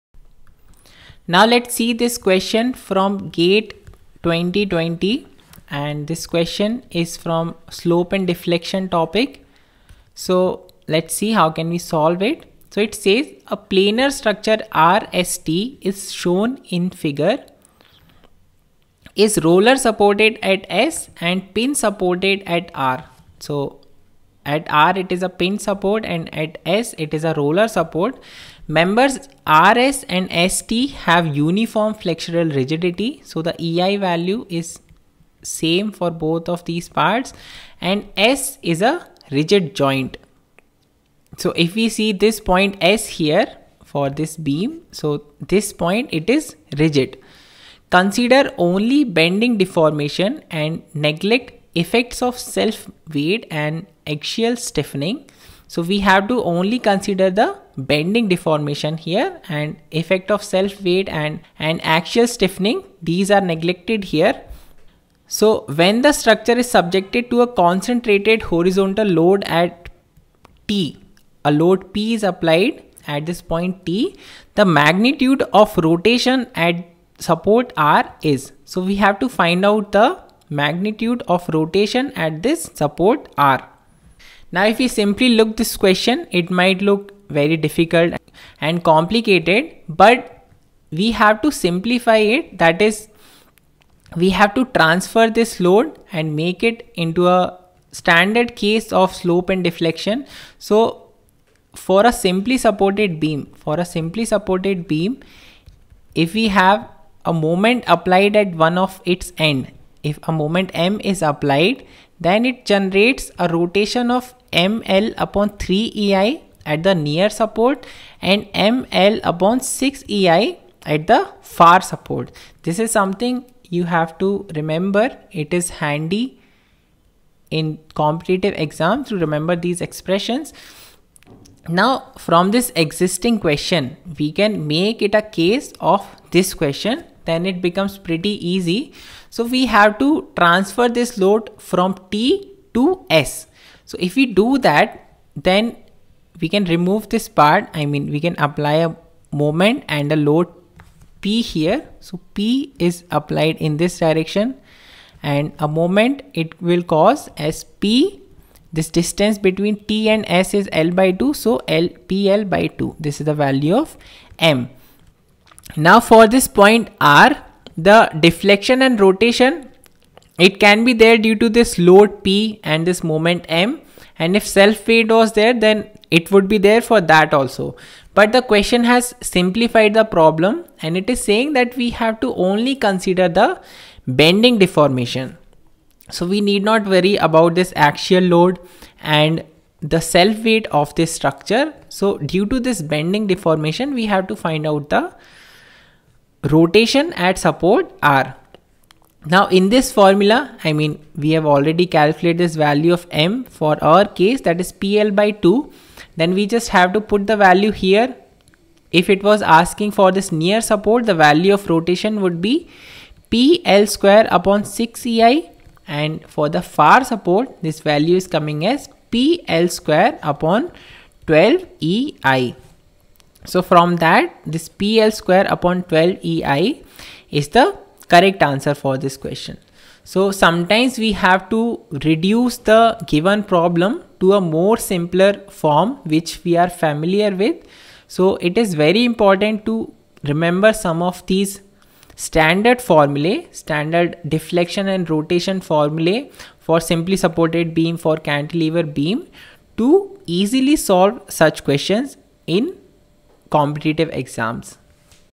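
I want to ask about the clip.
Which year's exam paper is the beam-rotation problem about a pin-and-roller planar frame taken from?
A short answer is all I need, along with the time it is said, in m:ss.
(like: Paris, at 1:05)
2020, at 0:03.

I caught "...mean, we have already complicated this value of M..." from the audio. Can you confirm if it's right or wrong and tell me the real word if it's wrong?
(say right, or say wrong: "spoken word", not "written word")
wrong: "calculated", not "complicated".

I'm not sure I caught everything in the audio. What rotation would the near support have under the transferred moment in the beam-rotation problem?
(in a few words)
PL²/6EI.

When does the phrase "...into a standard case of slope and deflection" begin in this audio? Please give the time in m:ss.
1:36.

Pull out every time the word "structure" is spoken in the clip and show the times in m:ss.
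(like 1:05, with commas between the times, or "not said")
0:14, 1:06, 3:11.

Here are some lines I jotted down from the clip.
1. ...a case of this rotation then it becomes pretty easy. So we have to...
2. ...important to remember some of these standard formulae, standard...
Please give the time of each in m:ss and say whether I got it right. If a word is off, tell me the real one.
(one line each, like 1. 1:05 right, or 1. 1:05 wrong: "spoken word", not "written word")
1. 2:15 wrong: "question", not "rotation"
2. 3:59 right.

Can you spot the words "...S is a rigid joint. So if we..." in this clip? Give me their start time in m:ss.
0:38.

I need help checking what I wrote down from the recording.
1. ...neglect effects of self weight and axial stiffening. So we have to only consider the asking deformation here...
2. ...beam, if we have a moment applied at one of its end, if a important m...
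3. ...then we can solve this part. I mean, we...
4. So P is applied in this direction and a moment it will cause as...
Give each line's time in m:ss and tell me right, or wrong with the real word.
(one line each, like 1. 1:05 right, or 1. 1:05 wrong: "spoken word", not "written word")
1. 0:50 wrong: "bending", not "asking"
2. 1:44 wrong: "moment", not "important"
3. 2:25 wrong: "remove", not "solve"
4. 2:31 right.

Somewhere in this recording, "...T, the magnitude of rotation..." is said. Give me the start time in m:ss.
1:13.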